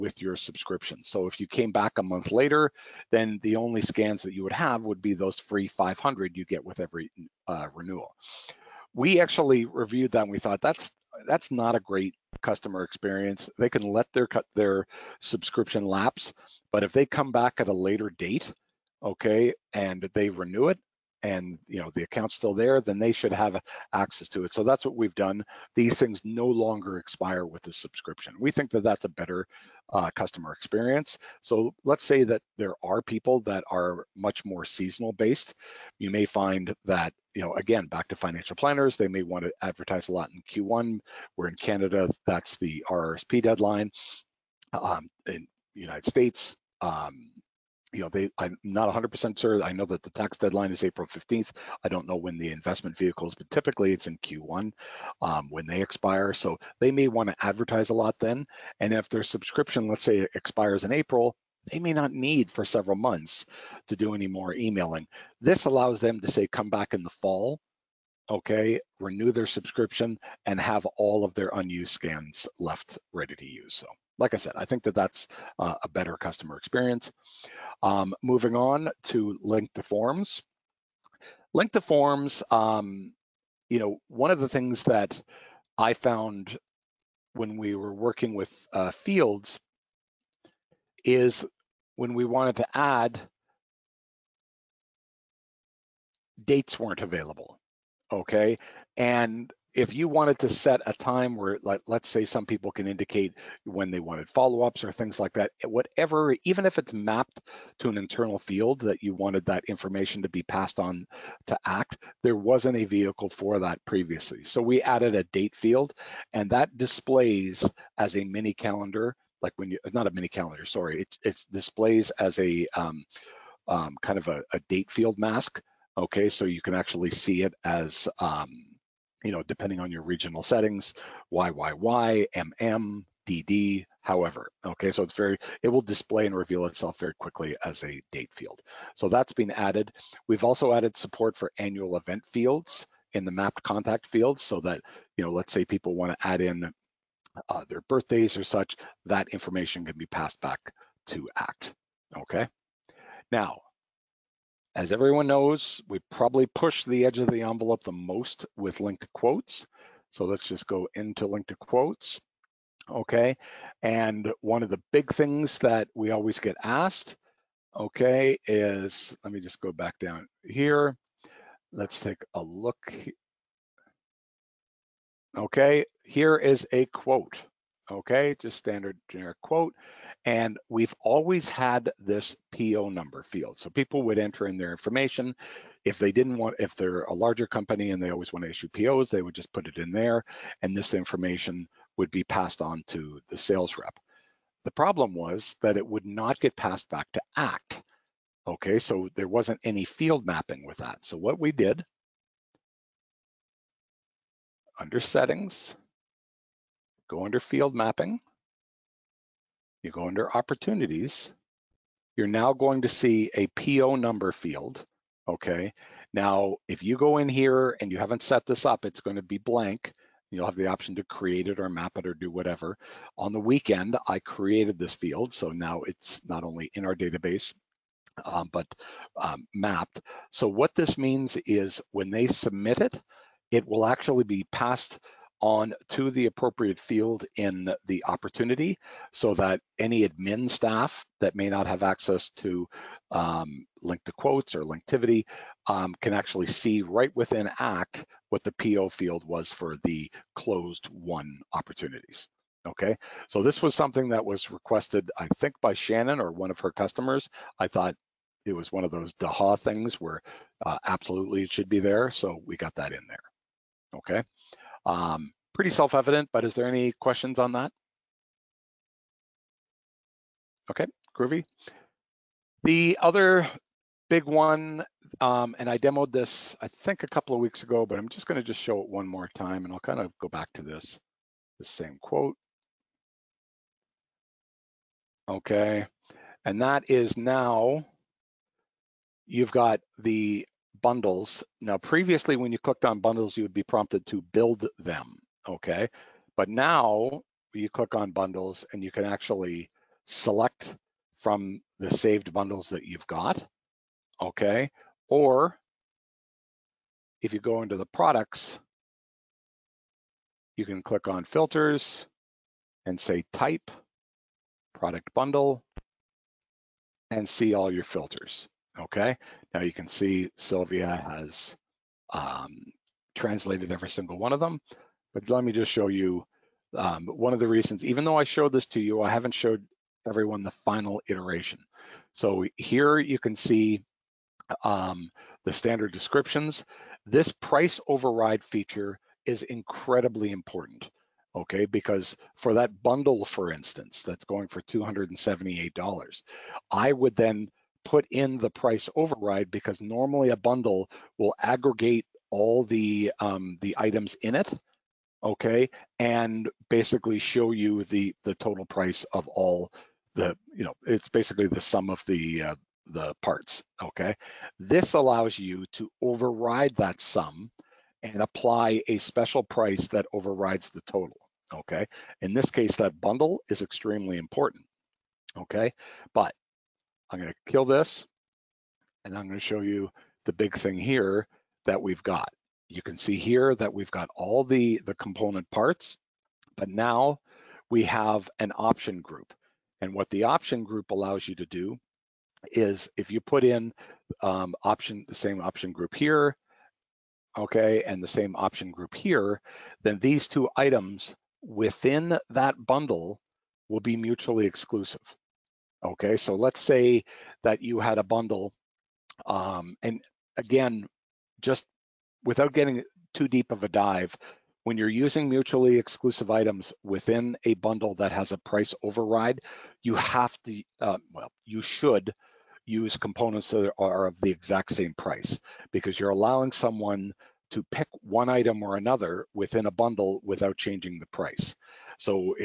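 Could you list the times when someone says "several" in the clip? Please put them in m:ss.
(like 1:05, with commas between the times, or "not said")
1:02.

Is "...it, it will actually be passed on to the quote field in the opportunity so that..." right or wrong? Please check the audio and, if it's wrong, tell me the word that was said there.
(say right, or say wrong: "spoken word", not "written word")
wrong: "appropriate", not "quote".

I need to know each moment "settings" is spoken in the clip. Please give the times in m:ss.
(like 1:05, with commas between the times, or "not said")
2:10, 3:24.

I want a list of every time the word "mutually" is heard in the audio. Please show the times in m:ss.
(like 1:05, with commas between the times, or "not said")
6:43, 6:55.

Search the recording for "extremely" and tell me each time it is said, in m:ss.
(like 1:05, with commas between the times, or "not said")
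6:13.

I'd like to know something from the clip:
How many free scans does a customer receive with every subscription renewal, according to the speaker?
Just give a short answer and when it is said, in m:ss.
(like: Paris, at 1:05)
500, at 0:05.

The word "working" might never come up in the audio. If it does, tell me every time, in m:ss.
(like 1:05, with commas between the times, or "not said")
1:27.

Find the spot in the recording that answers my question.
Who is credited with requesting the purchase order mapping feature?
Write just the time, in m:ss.
4:15.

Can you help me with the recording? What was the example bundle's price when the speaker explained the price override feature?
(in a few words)
$278.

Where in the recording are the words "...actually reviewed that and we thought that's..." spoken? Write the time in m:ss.
0:09.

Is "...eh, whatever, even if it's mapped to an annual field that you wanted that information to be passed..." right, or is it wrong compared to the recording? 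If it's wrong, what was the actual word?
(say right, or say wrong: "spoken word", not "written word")
wrong: "internal", not "annual".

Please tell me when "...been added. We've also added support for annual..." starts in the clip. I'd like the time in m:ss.
2:19.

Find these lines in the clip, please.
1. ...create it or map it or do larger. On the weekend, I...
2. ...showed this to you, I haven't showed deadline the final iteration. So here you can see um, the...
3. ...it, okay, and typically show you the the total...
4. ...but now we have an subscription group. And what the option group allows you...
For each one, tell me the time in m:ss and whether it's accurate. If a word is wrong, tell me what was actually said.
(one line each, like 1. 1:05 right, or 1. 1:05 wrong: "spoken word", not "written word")
1. 3:41 wrong: "whatever", not "larger"
2. 5:28 wrong: "everyone", not "deadline"
3. 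5:54 wrong: "basically", not "typically"
4. 6:26 wrong: "option", not "subscription".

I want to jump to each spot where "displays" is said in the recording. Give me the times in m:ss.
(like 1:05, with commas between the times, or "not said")
1:56, 2:01, 2:15.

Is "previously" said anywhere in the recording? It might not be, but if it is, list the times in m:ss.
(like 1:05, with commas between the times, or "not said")
1:53, 4:51.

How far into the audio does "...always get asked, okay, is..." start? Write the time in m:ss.
2:46.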